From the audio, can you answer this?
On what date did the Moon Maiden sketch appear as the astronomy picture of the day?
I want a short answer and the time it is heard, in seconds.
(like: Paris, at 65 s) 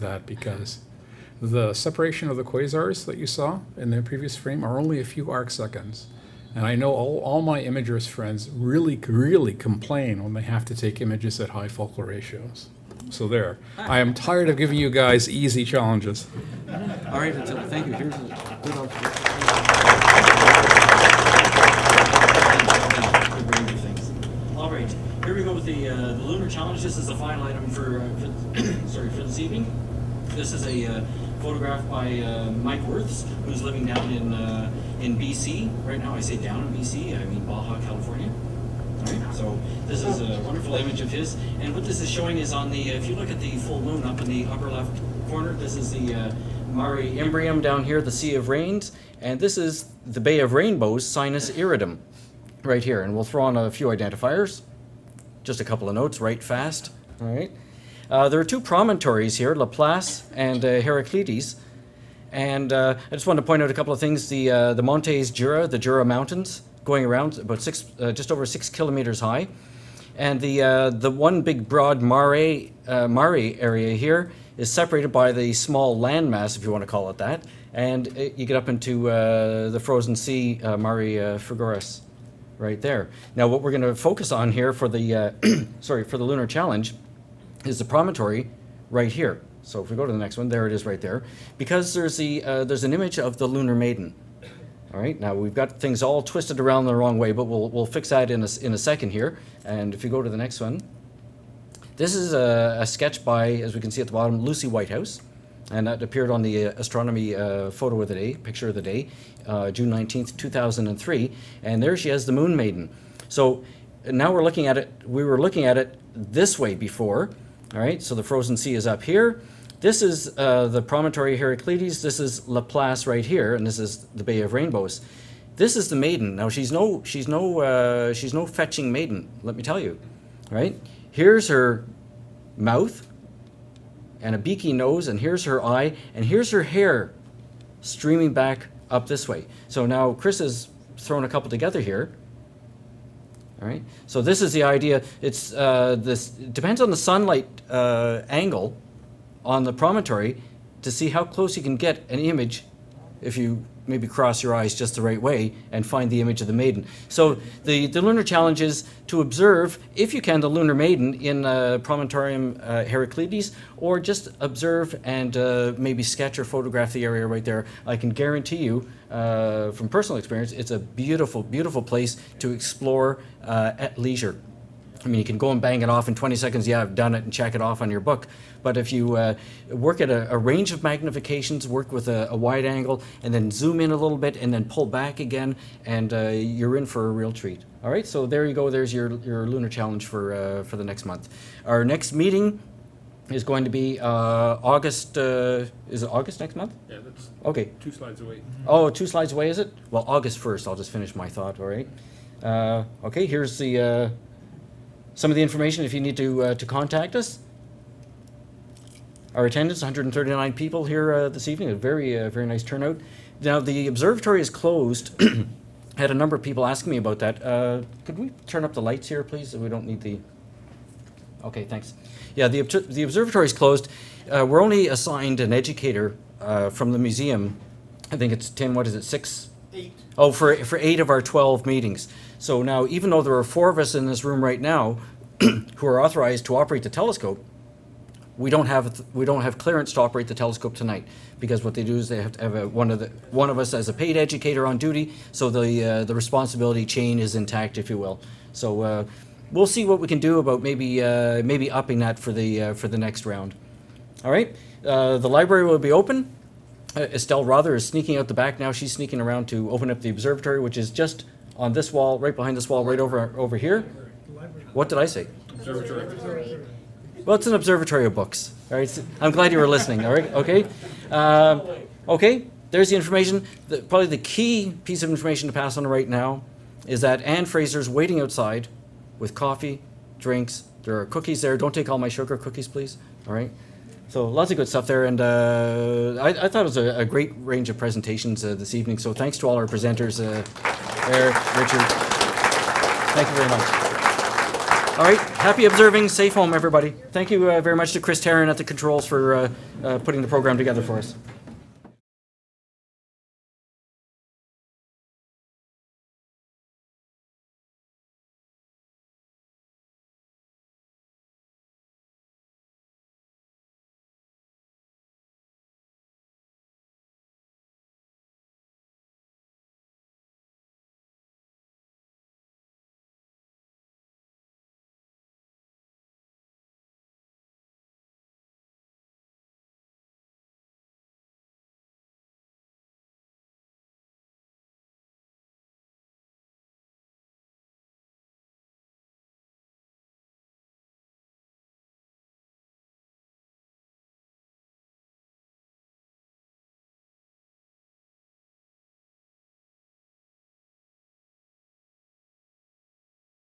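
June 19th, 2003, at 109 s.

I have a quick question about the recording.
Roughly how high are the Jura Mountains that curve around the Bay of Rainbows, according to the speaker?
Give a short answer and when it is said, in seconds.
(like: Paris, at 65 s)
just over 6 kilometers, at 68 s.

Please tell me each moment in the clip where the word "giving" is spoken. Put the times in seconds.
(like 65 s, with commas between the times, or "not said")
14 s.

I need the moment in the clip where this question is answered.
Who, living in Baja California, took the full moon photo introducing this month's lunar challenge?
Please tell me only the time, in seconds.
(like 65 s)
32 s.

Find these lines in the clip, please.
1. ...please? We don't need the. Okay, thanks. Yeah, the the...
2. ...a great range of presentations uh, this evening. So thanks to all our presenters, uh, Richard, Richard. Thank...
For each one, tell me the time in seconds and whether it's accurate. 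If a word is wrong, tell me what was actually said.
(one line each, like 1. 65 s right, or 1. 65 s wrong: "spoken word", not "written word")
1. 219 s right
2. 286 s wrong: "Eric", not "Richard".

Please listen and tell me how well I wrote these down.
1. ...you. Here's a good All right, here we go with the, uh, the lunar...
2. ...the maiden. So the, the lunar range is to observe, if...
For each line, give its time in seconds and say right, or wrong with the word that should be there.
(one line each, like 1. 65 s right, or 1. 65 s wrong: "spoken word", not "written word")
1. 17 s right
2. 156 s wrong: "challenge", not "range".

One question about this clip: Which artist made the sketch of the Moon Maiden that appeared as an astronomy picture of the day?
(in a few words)
Lucy Whitehouse.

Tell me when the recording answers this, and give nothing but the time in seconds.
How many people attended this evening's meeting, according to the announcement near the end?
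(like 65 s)
209 s.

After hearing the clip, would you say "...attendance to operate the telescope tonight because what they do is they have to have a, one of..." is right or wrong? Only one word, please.
wrong.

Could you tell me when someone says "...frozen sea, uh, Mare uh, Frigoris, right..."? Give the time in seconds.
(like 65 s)
79 s.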